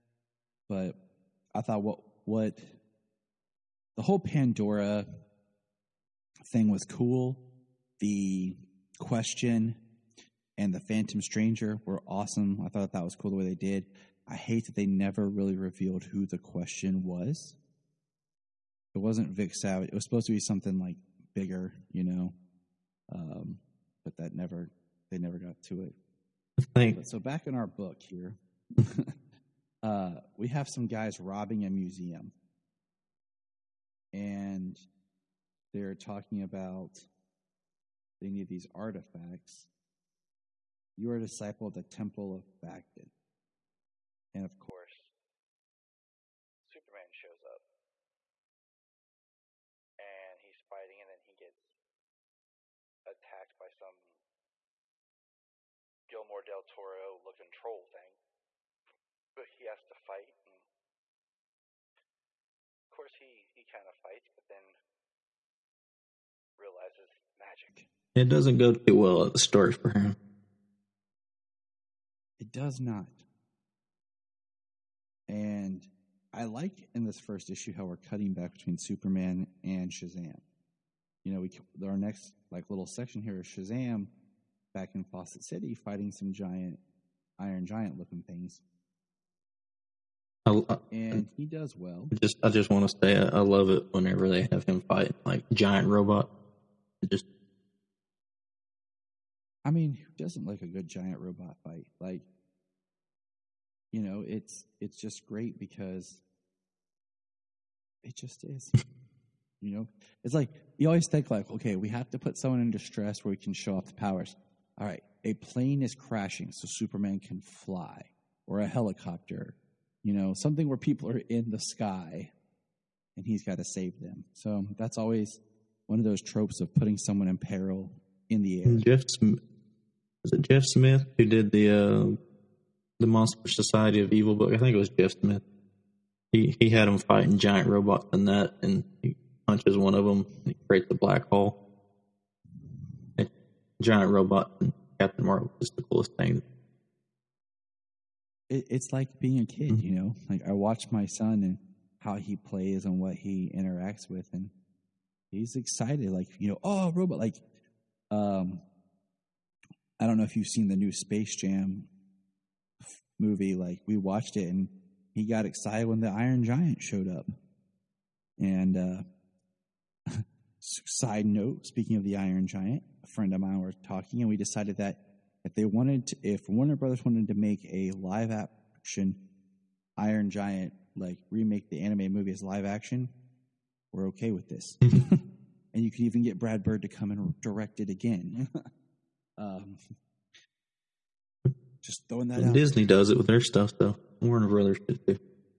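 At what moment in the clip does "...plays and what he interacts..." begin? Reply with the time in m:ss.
2:32.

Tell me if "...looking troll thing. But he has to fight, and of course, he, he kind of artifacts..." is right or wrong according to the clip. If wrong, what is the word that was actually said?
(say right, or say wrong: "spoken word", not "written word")
wrong: "fights", not "artifacts".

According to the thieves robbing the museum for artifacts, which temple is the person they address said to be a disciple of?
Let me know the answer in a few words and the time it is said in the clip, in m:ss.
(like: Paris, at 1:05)
Temple of Baghdad, at 0:41.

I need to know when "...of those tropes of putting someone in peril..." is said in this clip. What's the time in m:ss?
2:05.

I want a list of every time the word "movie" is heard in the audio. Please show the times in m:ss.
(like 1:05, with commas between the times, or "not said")
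2:43, 3:02.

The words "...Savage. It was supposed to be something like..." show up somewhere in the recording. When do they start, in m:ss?
0:19.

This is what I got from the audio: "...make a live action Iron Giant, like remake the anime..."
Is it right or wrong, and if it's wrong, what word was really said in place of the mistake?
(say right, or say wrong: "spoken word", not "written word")
right.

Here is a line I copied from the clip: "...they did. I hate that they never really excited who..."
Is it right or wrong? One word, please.
wrong.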